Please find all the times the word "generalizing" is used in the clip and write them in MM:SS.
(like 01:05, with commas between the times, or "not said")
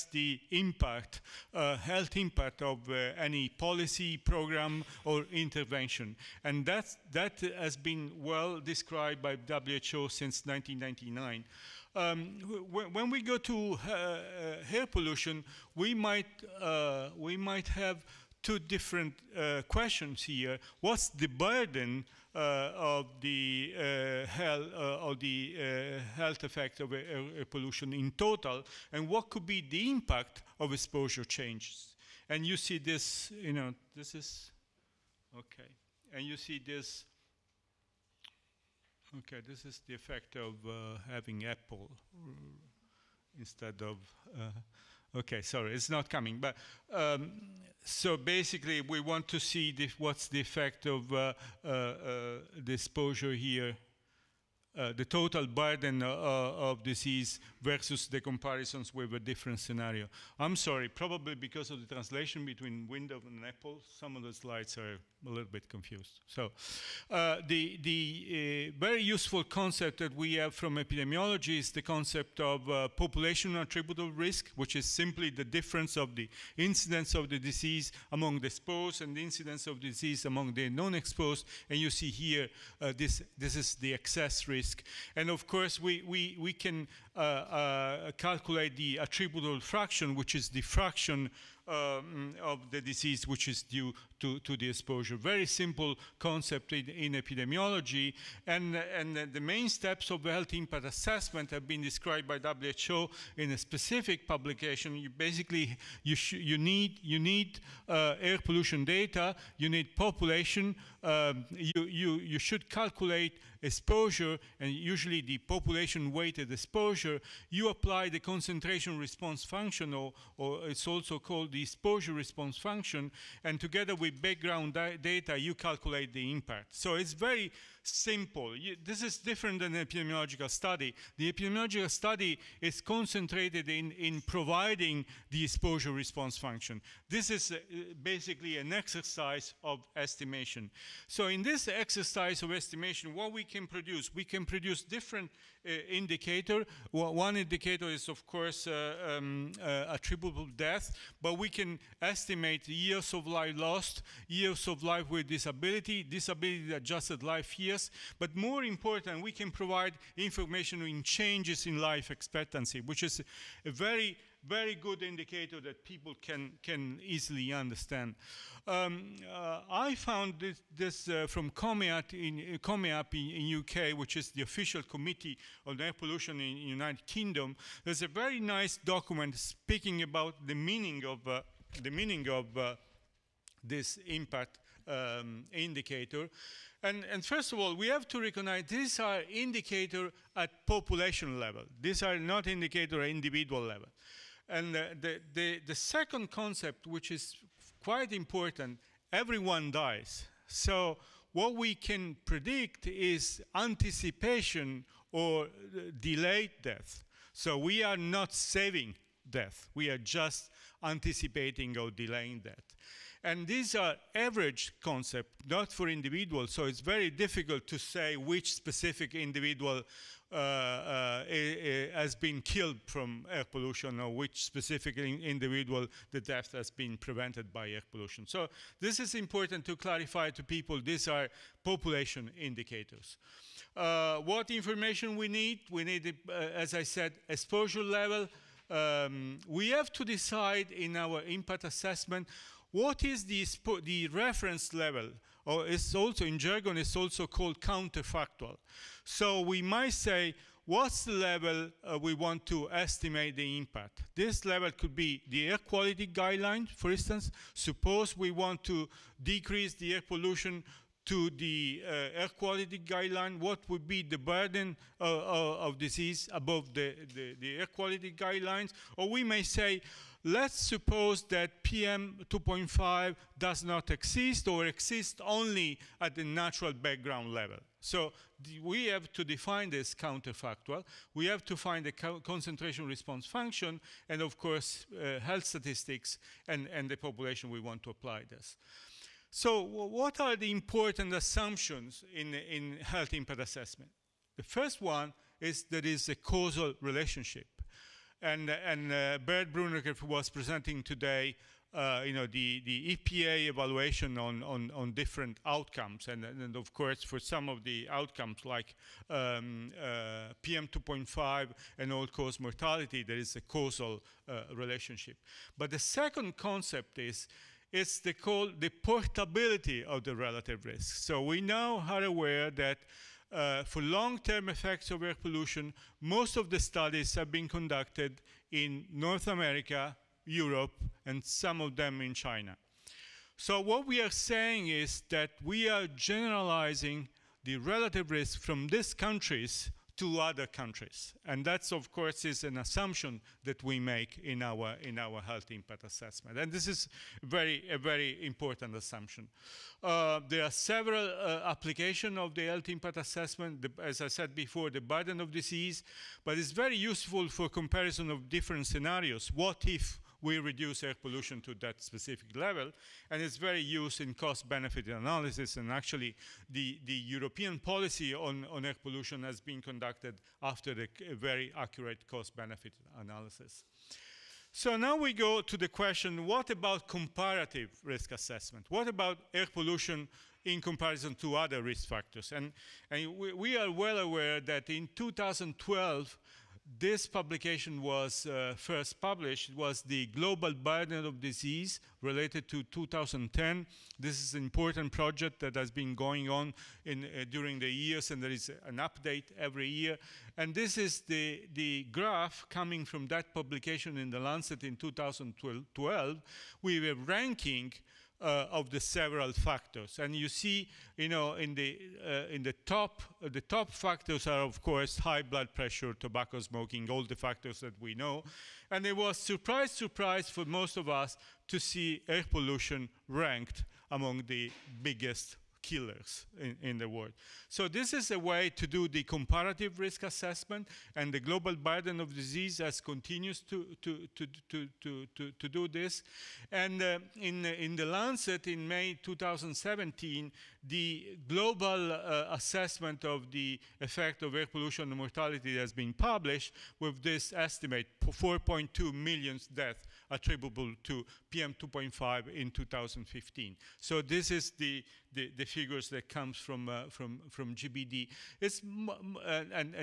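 05:35.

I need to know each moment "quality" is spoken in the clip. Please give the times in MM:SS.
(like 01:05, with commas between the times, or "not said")
04:15, 04:22, 04:27.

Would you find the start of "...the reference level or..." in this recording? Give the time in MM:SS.
04:03.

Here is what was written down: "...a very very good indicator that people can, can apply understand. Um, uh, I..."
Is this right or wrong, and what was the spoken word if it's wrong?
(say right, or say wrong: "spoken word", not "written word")
wrong: "easily", not "apply".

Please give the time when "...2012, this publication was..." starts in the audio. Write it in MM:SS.
06:24.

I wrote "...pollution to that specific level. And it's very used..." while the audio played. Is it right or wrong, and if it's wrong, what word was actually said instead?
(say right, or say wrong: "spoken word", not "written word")
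right.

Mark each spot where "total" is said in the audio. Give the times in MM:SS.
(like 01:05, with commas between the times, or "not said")
00:28, 00:55.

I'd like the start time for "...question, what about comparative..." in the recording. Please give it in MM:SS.
06:15.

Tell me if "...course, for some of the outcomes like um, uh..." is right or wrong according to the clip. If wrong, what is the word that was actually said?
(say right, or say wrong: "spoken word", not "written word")
right.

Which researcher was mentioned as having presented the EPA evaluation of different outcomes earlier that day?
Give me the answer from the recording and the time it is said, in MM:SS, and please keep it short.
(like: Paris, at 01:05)
Bert Brunekreef, at 04:59.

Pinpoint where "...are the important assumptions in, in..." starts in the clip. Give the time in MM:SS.
04:50.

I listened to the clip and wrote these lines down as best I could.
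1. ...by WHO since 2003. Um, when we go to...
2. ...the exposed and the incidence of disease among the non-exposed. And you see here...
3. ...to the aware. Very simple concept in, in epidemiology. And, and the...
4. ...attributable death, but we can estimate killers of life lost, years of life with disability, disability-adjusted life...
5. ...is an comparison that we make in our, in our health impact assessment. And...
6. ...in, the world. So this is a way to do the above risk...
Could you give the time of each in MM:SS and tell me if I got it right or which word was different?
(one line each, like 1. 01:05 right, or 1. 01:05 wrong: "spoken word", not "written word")
1. 00:09 wrong: "1999", not "2003"
2. 01:18 right
3. 01:34 wrong: "exposure", not "aware"
4. 02:29 wrong: "years", not "killers"
5. 05:42 wrong: "assumption", not "comparison"
6. 07:06 wrong: "comparative", not "above".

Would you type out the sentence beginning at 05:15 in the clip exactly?
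But the second concept is, it's the, call, the portability of the relative risk.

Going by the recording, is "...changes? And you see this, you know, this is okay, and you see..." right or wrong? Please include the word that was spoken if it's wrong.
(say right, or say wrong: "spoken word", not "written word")
right.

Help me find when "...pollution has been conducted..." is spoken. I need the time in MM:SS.
06:08.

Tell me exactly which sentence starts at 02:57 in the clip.
There's a very nice document speaking about the meaning of, uh, the meaning of uh, this impact um, indicator.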